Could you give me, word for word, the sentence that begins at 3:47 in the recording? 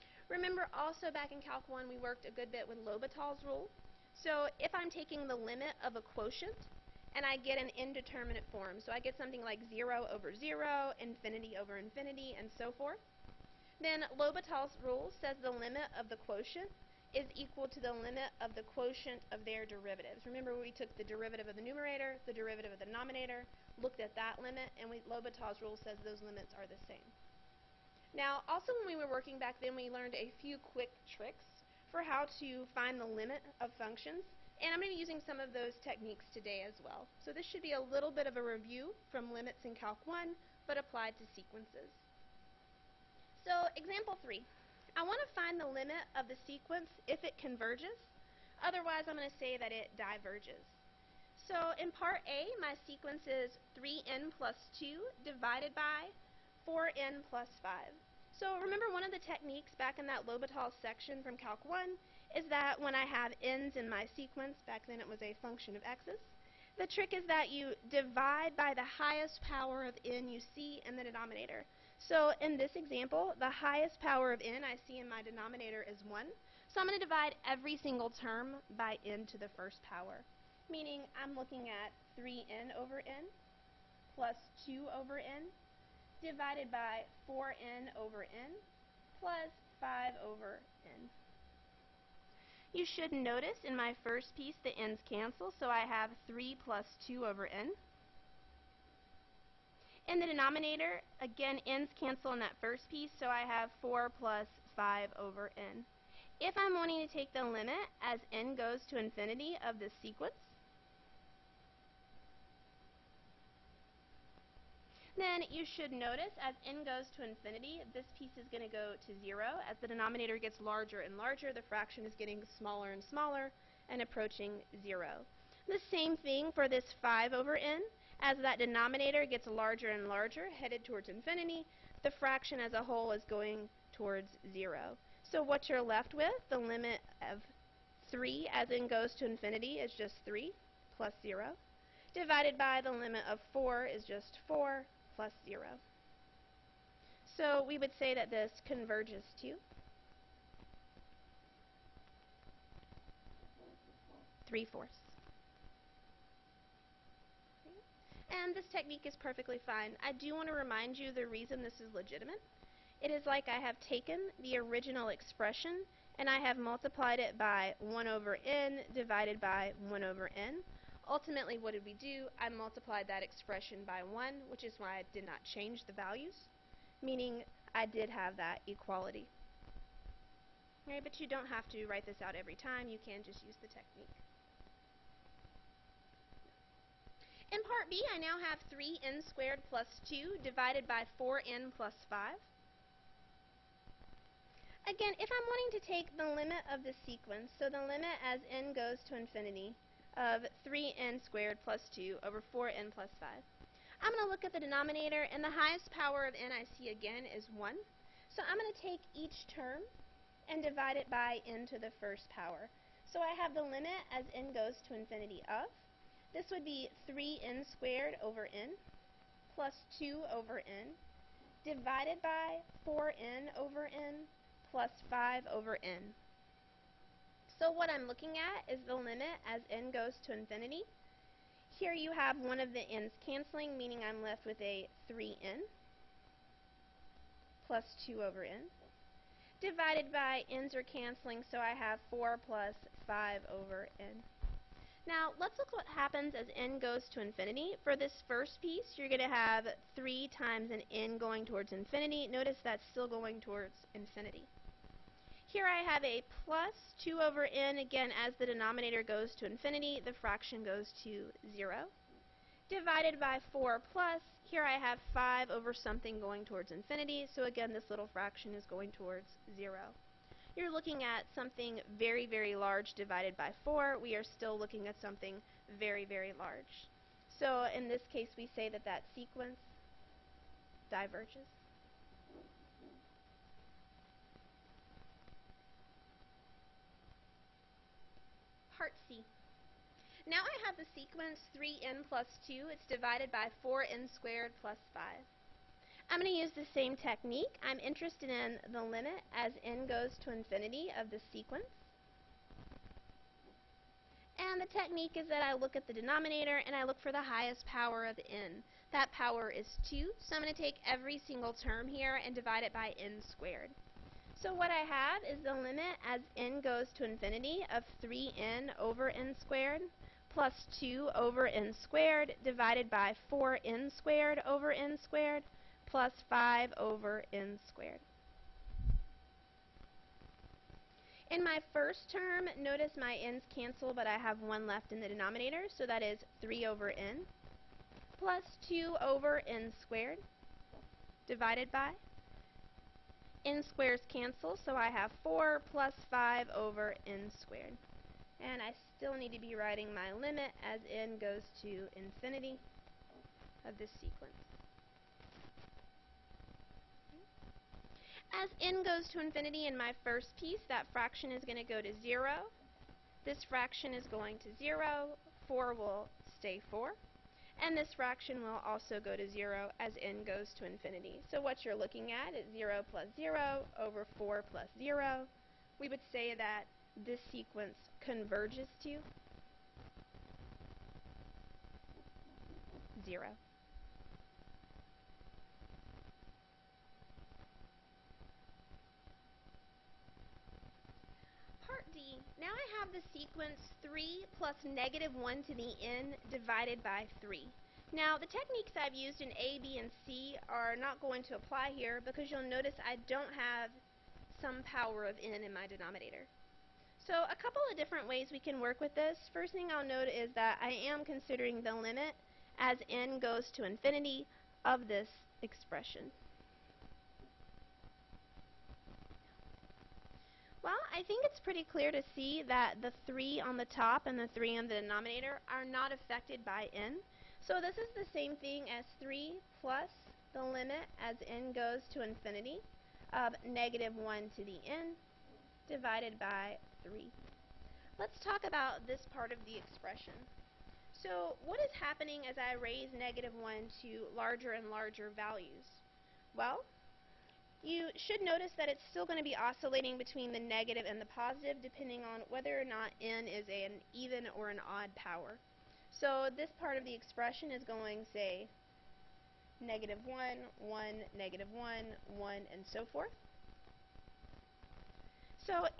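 So what I'm looking at is the limit as n goes to infinity.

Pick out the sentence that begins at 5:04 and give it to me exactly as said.
And the technique is that I look at the denominator and I look for the highest power of n.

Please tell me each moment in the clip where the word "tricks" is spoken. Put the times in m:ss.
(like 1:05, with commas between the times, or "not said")
0:31, 1:06.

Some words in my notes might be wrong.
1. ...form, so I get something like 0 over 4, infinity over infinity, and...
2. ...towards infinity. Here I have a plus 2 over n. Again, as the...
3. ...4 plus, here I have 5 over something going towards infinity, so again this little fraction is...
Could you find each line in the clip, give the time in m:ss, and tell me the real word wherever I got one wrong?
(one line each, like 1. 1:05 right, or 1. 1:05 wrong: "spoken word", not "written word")
1. 0:08 wrong: "0", not "4"
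2. 4:13 right
3. 4:23 right.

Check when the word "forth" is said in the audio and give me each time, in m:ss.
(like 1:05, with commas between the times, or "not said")
0:12, 7:42.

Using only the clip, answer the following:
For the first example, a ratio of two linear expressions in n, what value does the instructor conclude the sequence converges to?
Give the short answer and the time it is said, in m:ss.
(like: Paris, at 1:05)
3/4, at 2:34.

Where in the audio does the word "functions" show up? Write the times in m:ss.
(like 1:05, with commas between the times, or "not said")
0:33, 1:05.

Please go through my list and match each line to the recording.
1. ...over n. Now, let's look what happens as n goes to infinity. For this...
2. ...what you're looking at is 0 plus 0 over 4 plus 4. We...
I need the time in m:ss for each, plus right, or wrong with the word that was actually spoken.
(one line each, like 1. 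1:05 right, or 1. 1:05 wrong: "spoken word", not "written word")
1. 4:03 right
2. 6:11 wrong: "0", not "4".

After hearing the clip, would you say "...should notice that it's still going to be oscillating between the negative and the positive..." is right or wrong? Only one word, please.
right.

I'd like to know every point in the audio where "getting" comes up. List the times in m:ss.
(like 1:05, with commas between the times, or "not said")
2:02.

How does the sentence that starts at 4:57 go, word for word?
I'm interested in the limit as n goes to infinity of the sequence.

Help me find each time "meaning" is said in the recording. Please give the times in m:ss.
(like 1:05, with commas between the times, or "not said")
1:20, 2:57, 3:53.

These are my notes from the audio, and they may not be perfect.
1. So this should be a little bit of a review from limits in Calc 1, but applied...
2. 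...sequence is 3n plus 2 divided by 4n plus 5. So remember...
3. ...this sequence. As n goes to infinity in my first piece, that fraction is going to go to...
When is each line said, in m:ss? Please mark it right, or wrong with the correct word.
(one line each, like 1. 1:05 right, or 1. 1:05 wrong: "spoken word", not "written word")
1. 0:37 right
2. 0:52 right
3. 5:53 right.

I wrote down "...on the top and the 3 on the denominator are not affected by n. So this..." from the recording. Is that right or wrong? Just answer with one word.
right.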